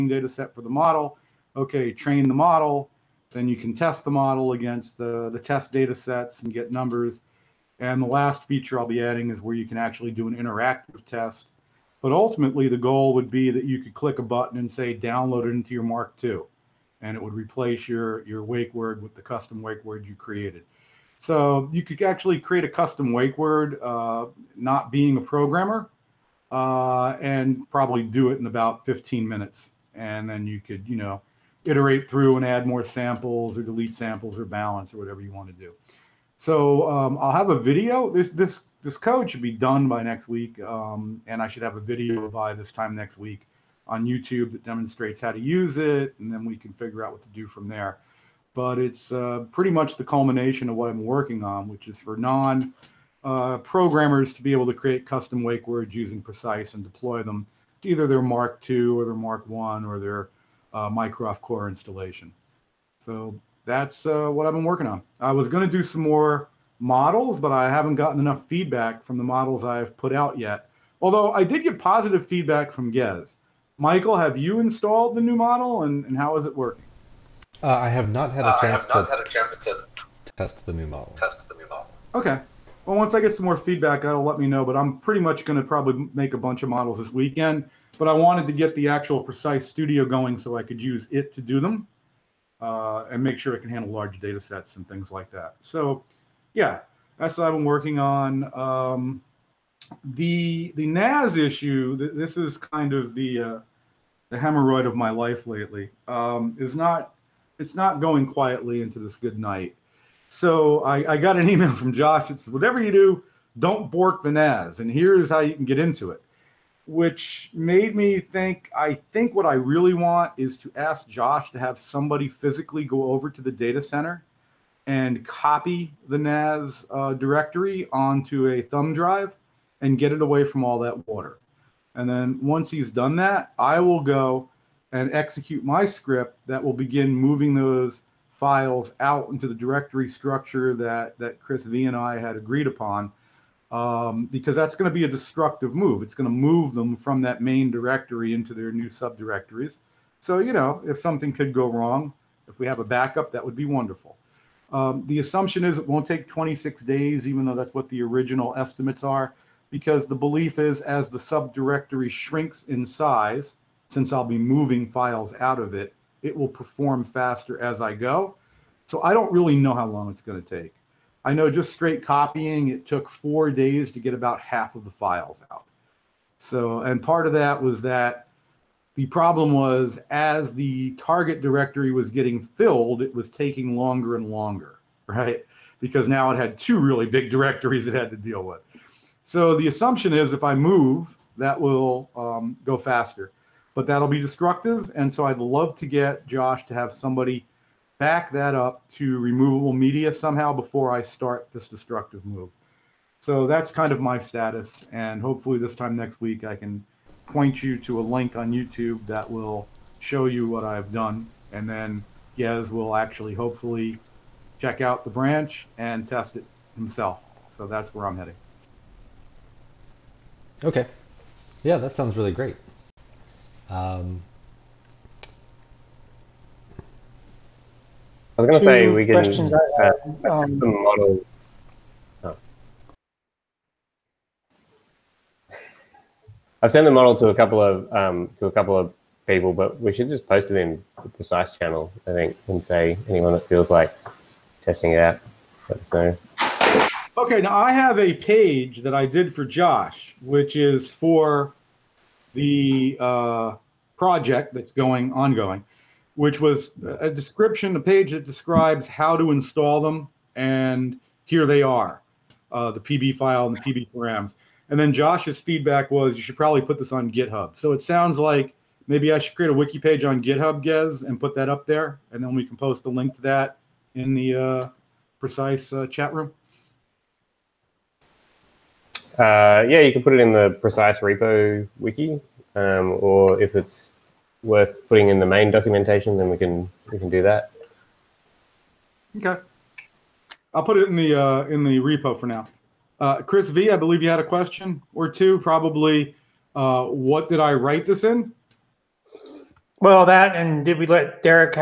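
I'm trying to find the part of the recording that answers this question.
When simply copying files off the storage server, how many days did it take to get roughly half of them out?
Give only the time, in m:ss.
2:53.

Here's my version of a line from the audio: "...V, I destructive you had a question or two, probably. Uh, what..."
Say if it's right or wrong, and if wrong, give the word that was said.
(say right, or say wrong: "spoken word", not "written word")
wrong: "believe", not "destructive".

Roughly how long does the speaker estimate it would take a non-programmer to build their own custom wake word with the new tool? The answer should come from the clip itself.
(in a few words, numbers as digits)
15 minutes.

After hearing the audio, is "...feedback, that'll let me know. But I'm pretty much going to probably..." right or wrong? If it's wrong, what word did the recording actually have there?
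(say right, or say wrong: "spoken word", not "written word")
right.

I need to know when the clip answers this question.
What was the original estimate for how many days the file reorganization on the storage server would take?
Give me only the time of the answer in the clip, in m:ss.
2:36.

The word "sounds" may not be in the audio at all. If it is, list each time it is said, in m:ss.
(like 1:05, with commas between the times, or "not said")
3:41, 4:27.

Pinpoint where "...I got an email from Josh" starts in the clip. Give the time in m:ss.
1:51.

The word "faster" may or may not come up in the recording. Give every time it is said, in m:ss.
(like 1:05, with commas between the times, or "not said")
2:47, 3:12.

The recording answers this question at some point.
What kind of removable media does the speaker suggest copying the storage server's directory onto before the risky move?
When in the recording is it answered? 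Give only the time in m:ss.
2:08.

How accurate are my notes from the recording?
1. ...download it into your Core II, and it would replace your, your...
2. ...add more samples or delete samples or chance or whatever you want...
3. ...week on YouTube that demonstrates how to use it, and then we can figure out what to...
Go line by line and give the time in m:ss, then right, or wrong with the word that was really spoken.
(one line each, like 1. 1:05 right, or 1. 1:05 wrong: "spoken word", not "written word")
1. 0:14 wrong: "Mark", not "Core"
2. 0:32 wrong: "balance", not "chance"
3. 0:43 right.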